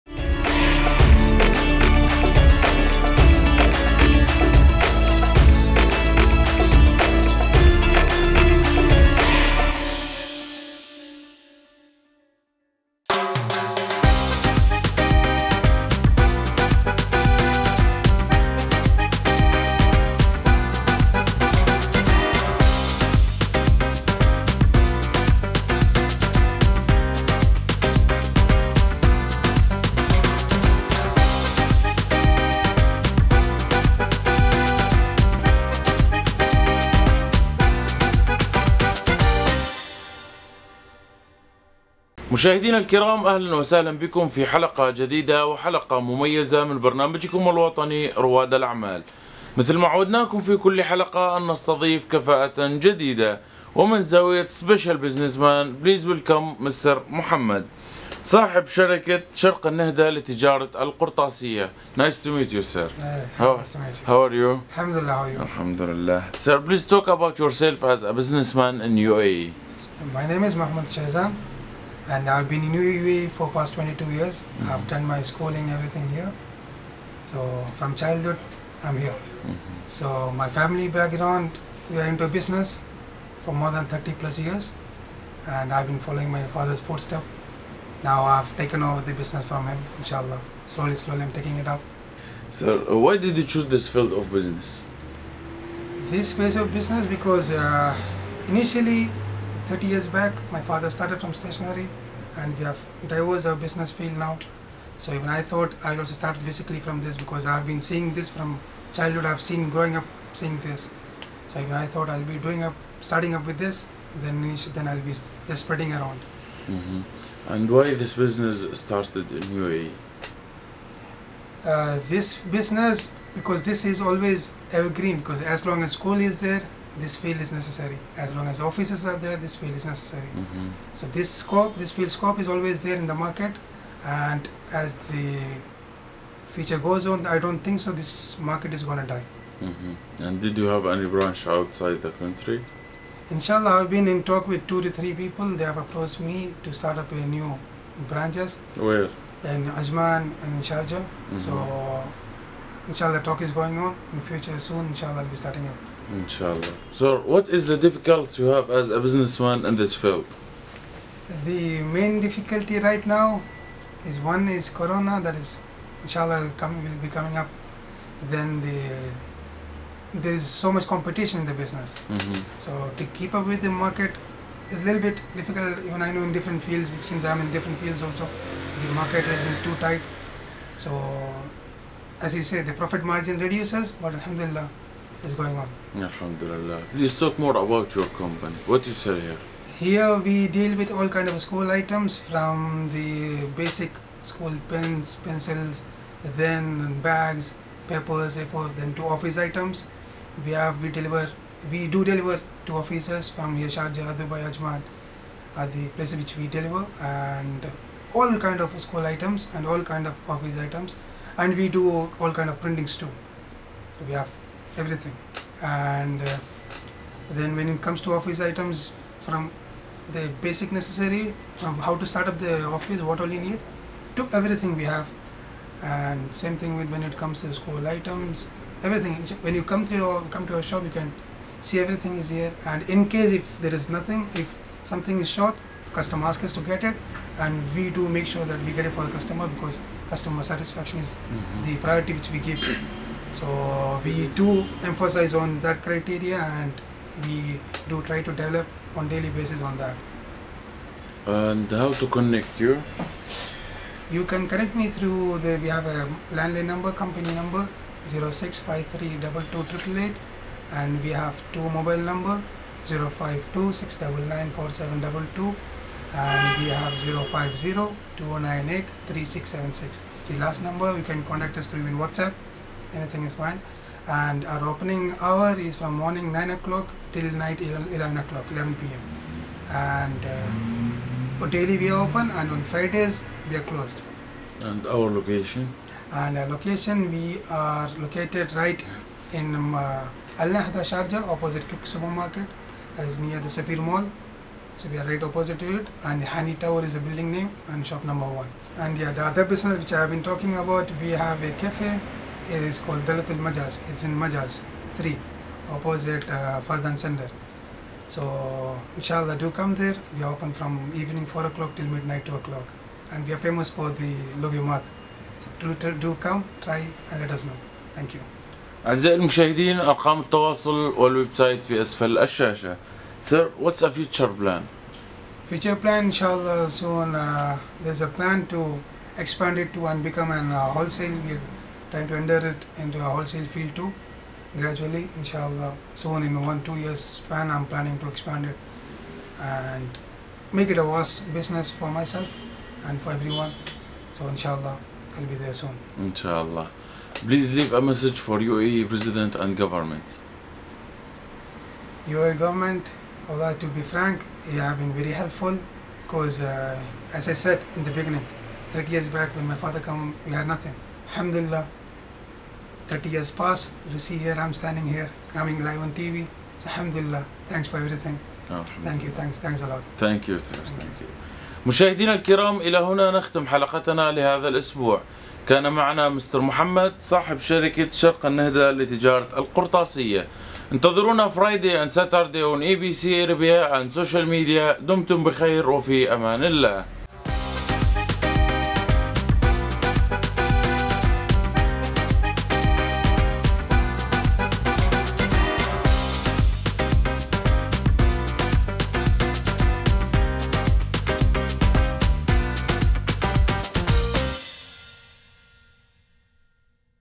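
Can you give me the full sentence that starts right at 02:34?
In future, soon, inshallah, I'll be starting up.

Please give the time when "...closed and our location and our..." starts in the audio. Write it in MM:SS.
04:43.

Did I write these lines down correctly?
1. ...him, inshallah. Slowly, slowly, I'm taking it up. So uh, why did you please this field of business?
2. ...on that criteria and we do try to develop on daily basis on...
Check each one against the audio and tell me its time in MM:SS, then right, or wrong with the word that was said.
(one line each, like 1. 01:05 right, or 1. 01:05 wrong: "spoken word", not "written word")
1. 01:29 wrong: "choose", not "please"
2. 04:05 right.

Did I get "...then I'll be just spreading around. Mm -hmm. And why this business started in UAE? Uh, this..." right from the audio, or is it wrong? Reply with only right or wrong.
right.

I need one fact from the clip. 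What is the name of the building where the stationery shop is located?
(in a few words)
Honey Tower.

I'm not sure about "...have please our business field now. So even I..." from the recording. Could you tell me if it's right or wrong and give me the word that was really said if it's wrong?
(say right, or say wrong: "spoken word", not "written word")
wrong: "diverse", not "please".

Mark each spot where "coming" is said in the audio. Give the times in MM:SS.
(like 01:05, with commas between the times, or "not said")
02:47, 06:05.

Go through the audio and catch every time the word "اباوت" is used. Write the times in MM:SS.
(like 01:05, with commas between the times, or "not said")
01:07.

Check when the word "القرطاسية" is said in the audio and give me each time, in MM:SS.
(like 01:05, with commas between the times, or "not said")
01:00, 06:19.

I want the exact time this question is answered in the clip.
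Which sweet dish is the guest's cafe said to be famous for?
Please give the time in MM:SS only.
05:14.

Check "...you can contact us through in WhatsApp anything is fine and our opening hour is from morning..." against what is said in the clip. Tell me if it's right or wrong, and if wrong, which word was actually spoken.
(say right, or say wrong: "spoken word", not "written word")
right.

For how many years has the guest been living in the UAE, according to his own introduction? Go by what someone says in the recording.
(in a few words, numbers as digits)
22 years.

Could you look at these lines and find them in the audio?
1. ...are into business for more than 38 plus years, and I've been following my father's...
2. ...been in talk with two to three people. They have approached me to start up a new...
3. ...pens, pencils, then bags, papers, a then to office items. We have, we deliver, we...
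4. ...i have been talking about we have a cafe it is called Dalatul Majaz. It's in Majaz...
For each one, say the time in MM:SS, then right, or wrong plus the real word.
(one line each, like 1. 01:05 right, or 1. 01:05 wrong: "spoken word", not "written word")
1. 01:22 wrong: "30", not "38"
2. 02:23 right
3. 03:14 right
4. 04:59 right.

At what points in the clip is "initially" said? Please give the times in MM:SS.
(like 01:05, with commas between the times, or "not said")
01:38.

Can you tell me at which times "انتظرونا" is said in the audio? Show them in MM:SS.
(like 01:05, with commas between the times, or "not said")
06:20.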